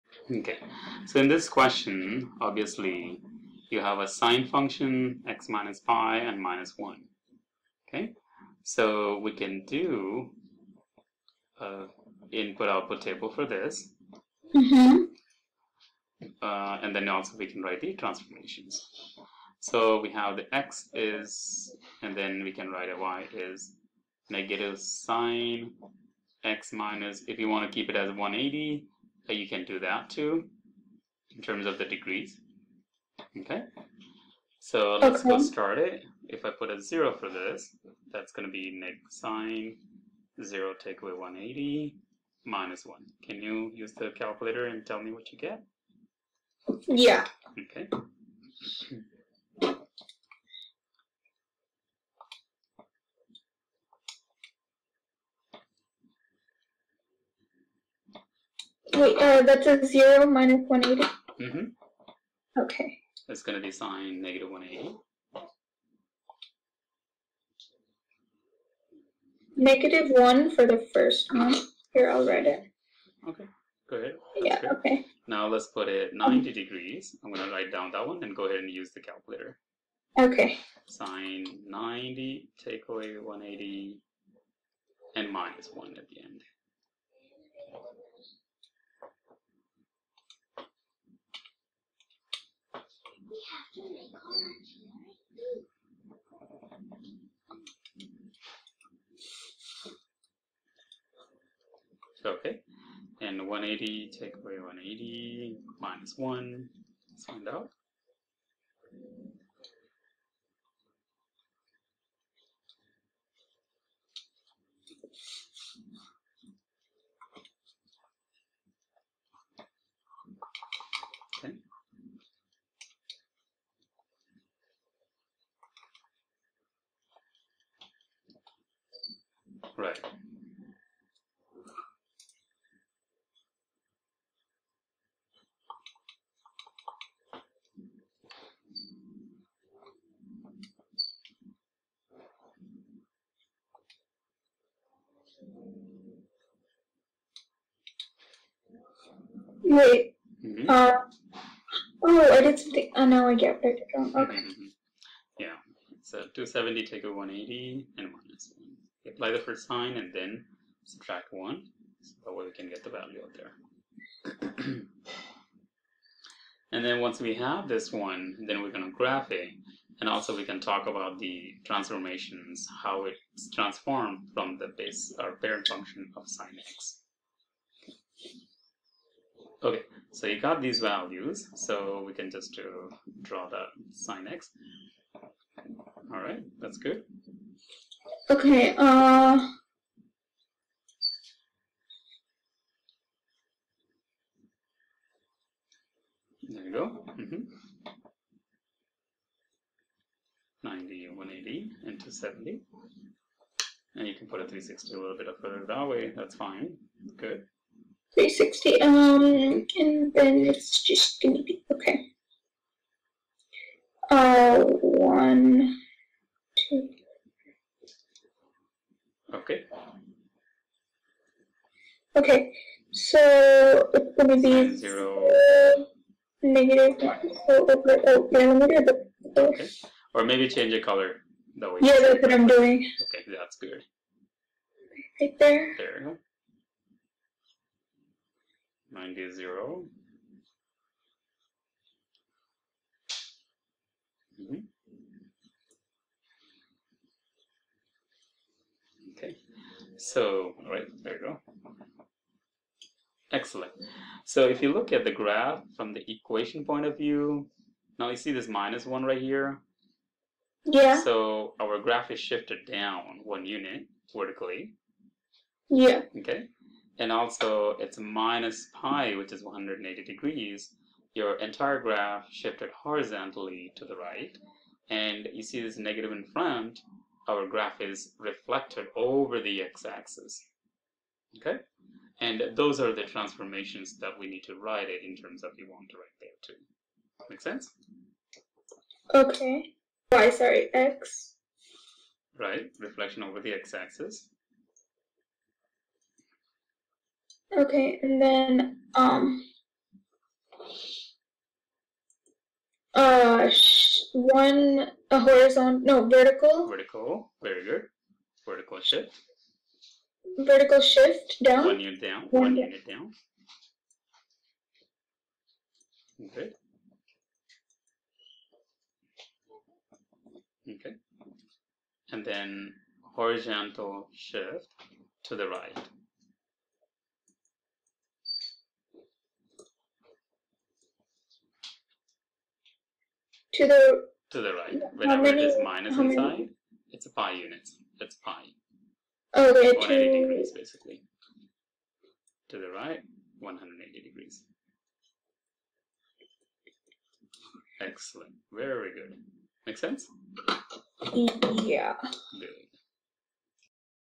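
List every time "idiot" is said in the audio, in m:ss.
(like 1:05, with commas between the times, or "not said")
not said.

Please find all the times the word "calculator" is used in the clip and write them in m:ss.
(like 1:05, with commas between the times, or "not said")
0:44, 1:19.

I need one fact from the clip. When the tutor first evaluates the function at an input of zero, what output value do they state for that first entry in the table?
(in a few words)
-1.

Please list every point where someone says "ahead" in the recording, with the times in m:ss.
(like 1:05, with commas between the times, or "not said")
1:13, 1:18.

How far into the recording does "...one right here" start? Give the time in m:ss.
4:18.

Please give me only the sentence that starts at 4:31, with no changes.
Your entire graph shifted horizontally to the right.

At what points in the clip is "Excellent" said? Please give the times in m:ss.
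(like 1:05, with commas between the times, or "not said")
4:13, 5:47.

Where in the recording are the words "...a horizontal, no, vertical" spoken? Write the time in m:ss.
5:05.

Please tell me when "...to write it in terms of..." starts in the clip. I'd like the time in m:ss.
4:44.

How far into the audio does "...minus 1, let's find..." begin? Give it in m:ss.
1:45.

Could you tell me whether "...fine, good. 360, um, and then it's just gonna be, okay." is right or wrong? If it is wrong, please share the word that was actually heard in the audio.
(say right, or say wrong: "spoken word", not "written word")
right.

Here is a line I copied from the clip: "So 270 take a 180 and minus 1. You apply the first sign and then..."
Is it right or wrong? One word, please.
right.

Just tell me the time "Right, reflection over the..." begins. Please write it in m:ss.
4:52.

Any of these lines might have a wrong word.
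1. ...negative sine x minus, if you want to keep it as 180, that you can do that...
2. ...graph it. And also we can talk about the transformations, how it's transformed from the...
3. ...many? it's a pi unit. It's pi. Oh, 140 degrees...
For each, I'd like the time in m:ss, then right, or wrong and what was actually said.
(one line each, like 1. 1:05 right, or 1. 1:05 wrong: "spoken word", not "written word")
1. 0:24 right
2. 2:48 right
3. 5:36 wrong: "180", not "140".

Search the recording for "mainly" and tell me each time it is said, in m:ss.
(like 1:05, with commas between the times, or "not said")
not said.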